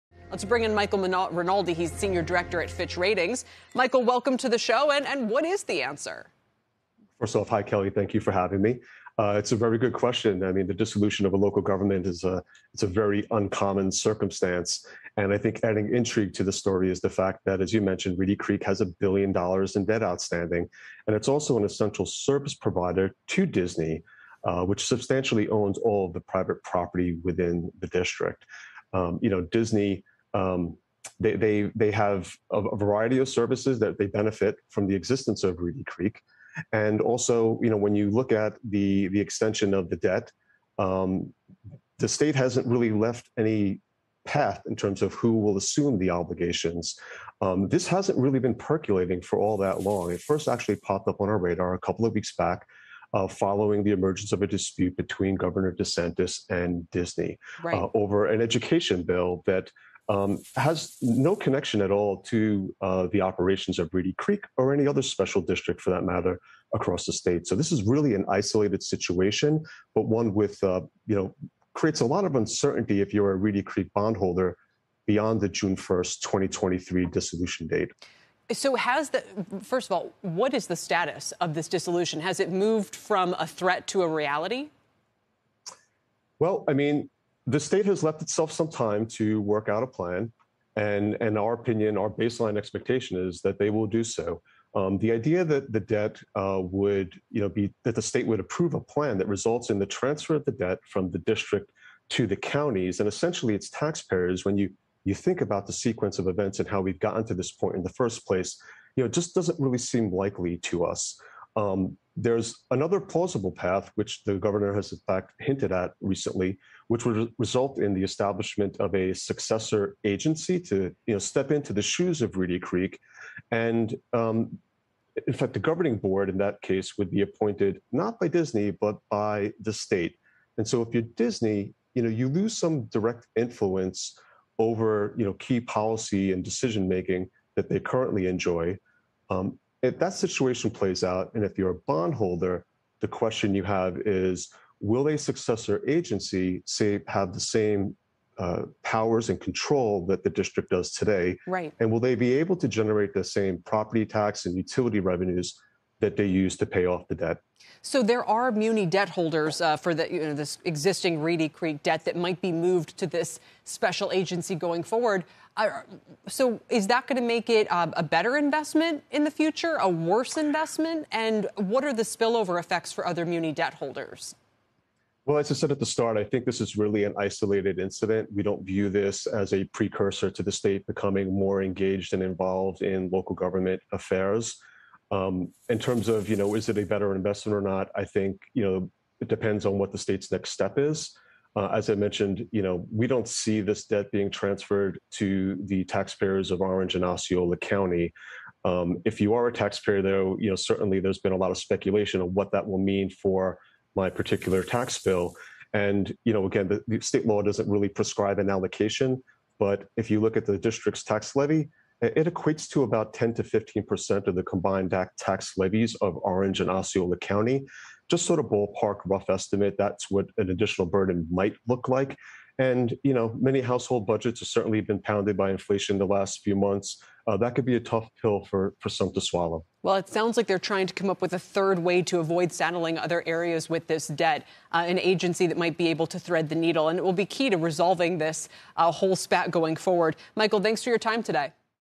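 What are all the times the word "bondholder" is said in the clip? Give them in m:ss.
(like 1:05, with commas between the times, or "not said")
1:13, 2:21.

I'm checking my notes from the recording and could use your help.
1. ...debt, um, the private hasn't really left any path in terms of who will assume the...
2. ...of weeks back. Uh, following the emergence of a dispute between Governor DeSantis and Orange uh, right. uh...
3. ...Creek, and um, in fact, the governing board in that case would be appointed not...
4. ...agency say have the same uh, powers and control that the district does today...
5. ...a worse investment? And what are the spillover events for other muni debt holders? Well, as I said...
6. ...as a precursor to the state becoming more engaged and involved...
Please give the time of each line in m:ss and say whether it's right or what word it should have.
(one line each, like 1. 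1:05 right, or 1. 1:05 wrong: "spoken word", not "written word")
1. 0:39 wrong: "state", not "private"
2. 0:52 wrong: "Disney", not "Orange"
3. 2:02 right
4. 2:25 right
5. 2:49 wrong: "effects", not "events"
6. 2:59 right.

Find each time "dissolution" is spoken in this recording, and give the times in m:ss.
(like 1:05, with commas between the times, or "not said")
0:10, 1:17, 1:21.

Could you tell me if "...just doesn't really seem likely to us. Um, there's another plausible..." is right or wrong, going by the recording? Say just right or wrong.
right.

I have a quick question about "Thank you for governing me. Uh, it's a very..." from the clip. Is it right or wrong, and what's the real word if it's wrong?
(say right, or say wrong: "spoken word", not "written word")
wrong: "having", not "governing".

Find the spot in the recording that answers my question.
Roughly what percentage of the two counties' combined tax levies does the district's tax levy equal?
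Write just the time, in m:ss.
3:33.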